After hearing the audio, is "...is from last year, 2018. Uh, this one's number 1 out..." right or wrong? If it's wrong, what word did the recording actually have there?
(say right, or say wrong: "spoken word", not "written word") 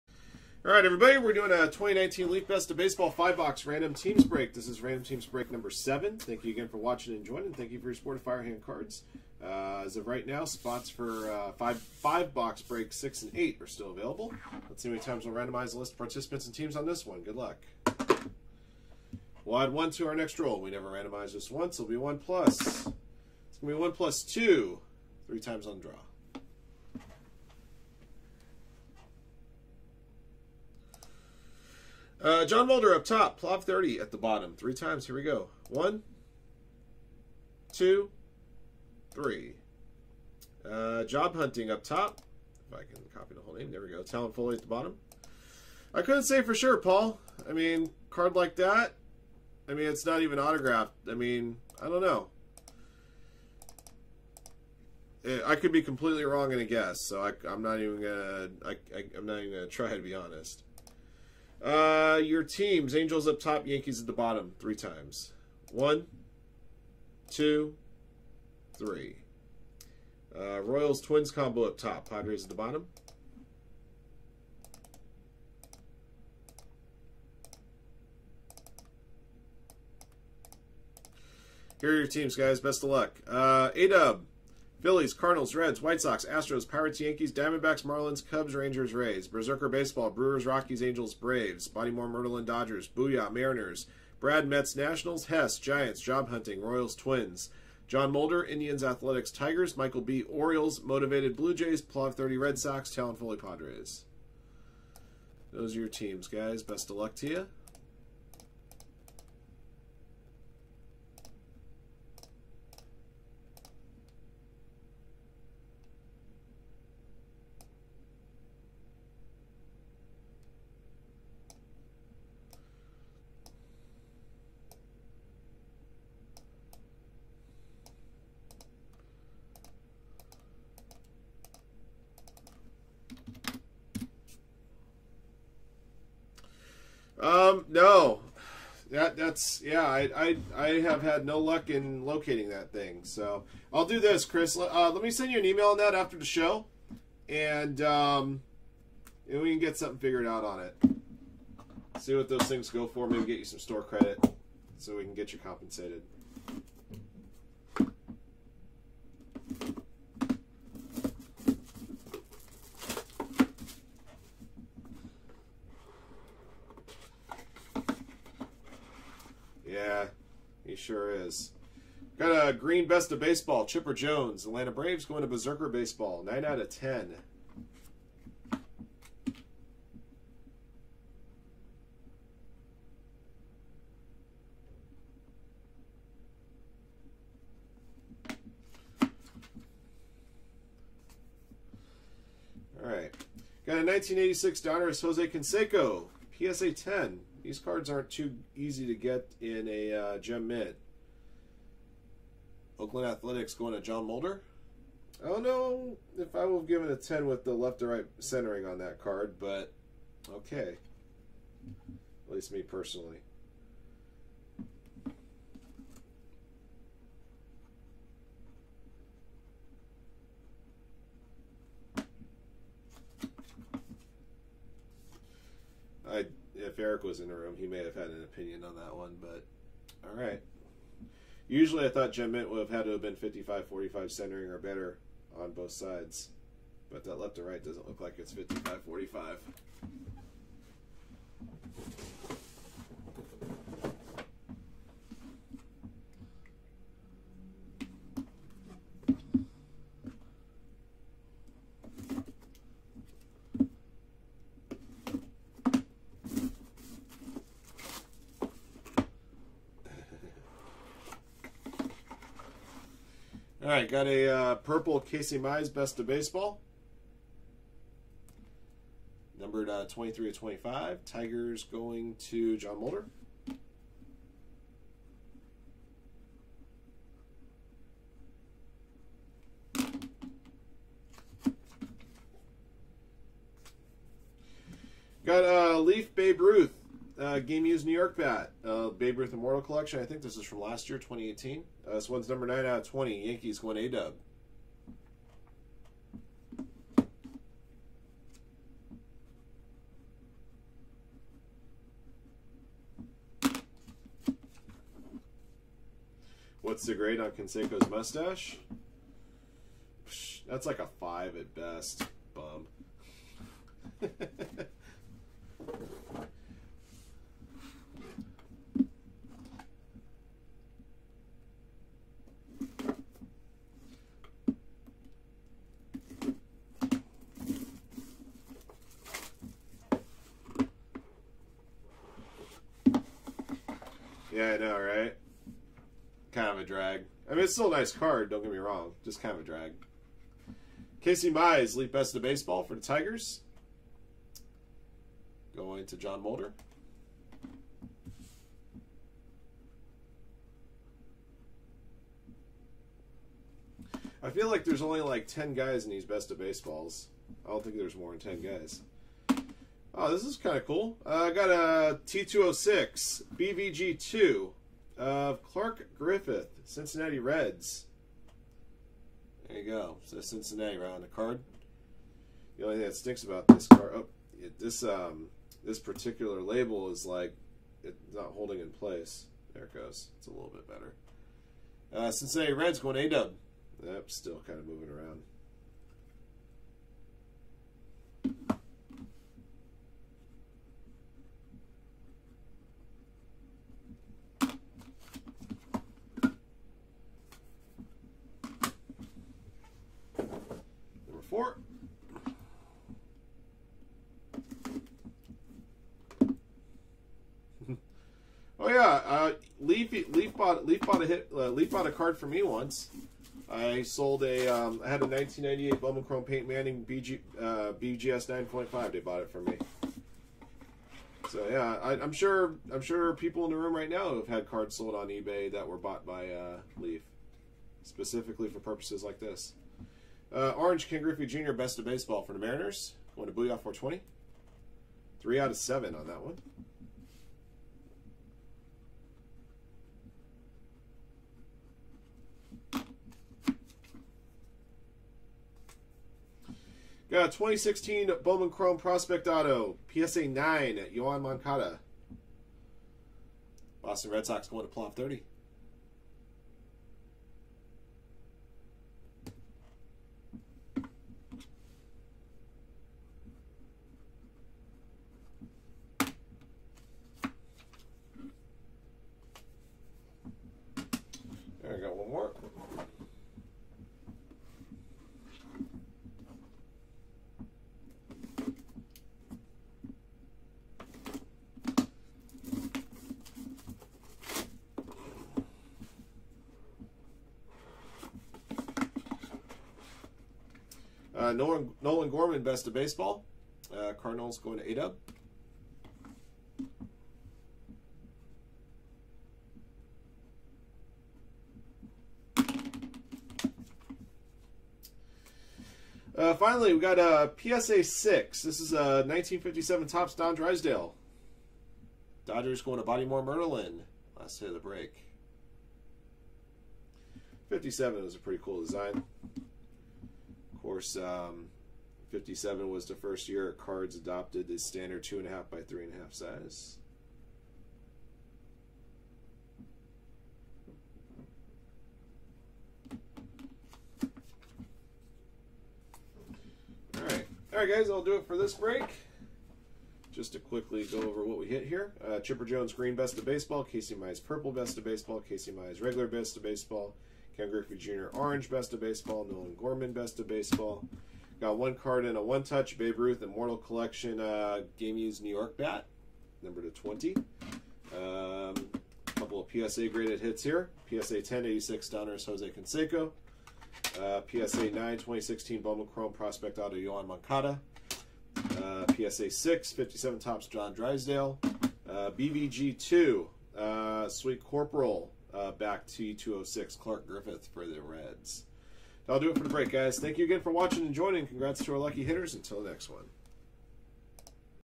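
wrong: "9", not "1".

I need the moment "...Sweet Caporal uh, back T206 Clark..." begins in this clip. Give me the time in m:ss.
9:34.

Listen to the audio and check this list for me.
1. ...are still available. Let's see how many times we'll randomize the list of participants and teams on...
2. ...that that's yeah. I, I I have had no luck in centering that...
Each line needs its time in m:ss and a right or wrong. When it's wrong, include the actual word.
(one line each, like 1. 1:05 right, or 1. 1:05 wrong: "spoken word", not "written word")
1. 0:13 right
2. 2:18 wrong: "locating", not "centering".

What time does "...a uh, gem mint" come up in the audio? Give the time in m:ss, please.
3:19.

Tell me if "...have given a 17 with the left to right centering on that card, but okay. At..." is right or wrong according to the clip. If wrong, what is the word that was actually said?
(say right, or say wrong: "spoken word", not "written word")
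wrong: "10", not "17".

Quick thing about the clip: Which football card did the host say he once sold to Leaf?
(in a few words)
1998 Bowman Chrome Peyton Manning.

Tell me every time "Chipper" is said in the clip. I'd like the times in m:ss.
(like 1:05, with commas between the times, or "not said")
2:53, 9:02.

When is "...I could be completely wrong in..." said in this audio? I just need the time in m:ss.
0:55.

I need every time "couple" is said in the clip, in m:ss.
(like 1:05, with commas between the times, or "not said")
9:19.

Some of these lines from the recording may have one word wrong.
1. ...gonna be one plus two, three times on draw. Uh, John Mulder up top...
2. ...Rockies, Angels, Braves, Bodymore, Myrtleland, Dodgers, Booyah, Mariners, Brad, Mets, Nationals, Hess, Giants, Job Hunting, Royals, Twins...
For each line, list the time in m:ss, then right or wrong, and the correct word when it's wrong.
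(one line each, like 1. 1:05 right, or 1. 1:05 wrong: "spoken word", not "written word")
1. 0:23 right
2. 1:30 right.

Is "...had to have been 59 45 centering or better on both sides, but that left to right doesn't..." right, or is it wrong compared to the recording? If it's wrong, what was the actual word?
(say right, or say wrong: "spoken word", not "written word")
wrong: "55", not "59".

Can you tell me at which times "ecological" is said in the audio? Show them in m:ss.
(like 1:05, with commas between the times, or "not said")
not said.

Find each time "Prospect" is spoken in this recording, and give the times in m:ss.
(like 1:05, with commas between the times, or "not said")
7:28, 9:26.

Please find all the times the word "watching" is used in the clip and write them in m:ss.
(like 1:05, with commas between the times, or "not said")
0:06, 9:40.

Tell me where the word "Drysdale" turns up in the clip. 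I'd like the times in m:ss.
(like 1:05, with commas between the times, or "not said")
8:30, 9:30.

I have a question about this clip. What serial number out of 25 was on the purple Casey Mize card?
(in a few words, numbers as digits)
23.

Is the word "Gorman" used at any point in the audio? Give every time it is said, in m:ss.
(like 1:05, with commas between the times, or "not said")
8:12, 9:09.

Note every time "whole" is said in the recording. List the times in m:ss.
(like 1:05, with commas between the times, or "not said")
0:43.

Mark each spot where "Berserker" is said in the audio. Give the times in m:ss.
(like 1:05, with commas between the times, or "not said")
1:29, 2:55.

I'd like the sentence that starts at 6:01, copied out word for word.
Uh, I got a T206 BVG2 of Clark Griffith, Cincinnati Reds.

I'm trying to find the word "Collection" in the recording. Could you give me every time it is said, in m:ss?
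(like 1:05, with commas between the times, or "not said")
4:49, 9:13.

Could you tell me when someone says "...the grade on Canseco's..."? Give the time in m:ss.
5:06.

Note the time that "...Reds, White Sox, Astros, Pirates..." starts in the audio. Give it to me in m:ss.
1:25.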